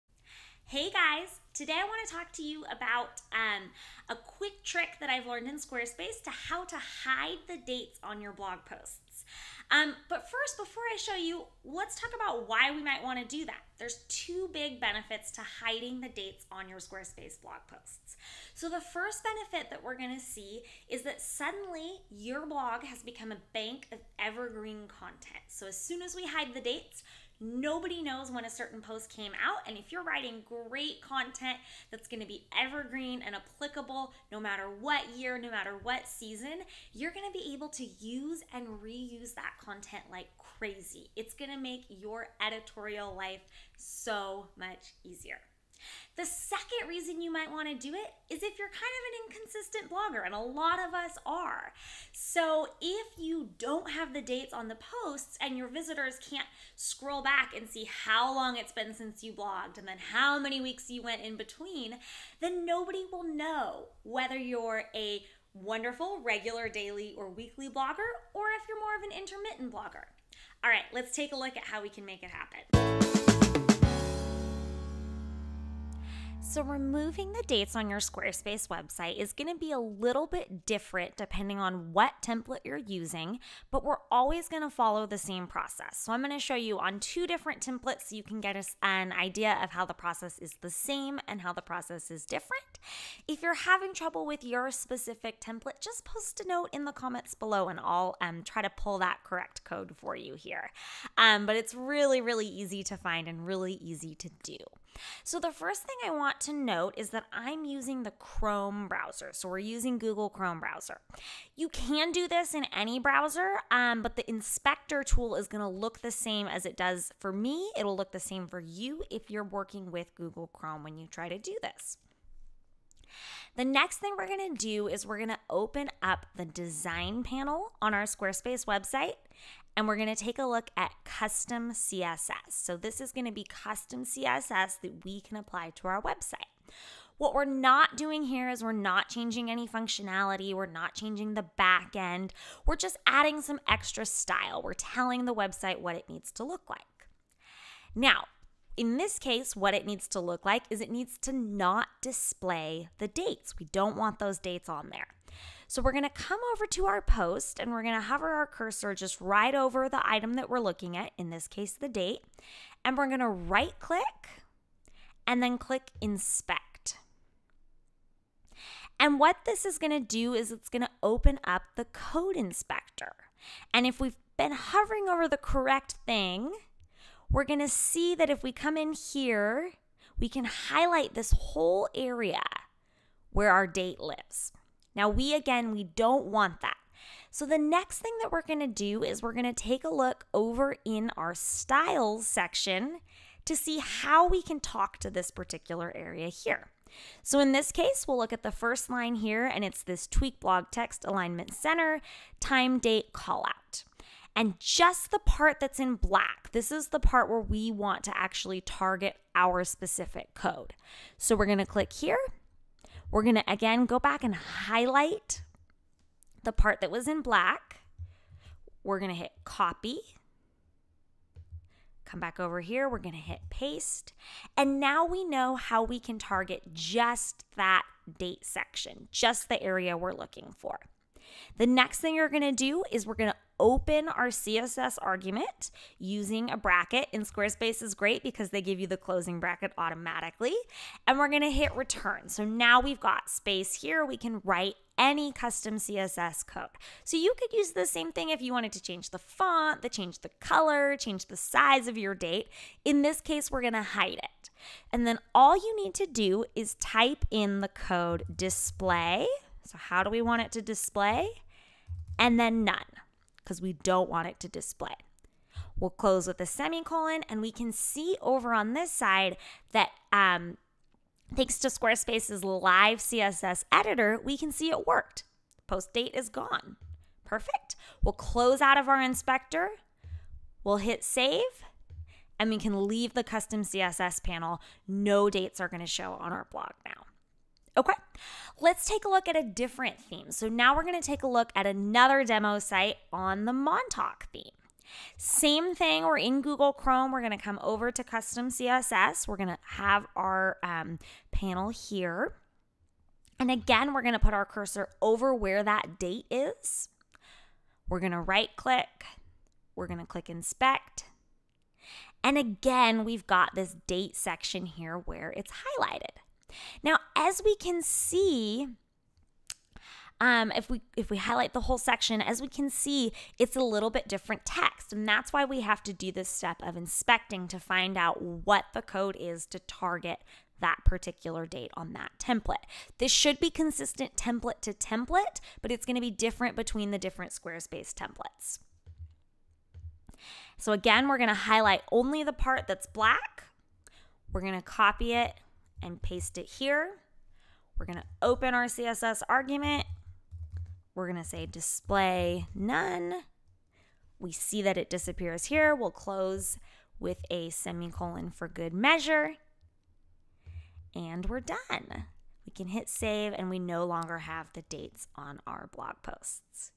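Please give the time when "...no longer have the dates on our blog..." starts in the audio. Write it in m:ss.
6:03.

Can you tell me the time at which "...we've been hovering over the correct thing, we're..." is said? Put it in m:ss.
2:53.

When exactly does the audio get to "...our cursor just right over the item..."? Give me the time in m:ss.
2:38.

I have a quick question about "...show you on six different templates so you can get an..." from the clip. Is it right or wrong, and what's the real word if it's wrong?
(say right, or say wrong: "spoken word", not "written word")
wrong: "two", not "six".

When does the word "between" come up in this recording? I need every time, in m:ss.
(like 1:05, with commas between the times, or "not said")
1:01, 5:36.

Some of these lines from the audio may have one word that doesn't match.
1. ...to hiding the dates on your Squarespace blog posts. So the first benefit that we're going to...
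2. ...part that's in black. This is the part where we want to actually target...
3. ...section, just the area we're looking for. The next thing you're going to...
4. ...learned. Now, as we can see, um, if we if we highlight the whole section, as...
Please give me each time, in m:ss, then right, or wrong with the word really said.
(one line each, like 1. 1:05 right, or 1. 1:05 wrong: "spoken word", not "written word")
1. 0:15 right
2. 3:25 right
3. 3:48 right
4. 5:15 wrong: "highlighted", not "learned".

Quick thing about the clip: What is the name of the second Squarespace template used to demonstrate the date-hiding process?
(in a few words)
Montauk.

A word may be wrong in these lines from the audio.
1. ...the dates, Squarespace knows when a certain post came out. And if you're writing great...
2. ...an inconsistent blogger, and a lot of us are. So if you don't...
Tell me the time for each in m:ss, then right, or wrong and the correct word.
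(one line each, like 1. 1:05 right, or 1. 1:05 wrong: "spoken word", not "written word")
1. 0:26 wrong: "Nobody", not "Squarespace"
2. 0:49 right.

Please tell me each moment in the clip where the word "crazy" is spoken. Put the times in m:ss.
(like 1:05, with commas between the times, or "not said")
0:40.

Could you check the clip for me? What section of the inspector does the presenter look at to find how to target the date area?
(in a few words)
styles section.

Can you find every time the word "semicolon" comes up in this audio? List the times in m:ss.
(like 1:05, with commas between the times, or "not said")
4:26, 5:57.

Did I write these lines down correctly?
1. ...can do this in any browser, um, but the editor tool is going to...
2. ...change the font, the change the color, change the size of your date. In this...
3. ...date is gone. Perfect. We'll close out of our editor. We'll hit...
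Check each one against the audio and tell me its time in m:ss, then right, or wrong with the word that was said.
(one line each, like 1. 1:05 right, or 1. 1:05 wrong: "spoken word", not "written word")
1. 1:51 wrong: "inspector", not "editor"
2. 4:08 right
3. 4:35 wrong: "inspector", not "editor".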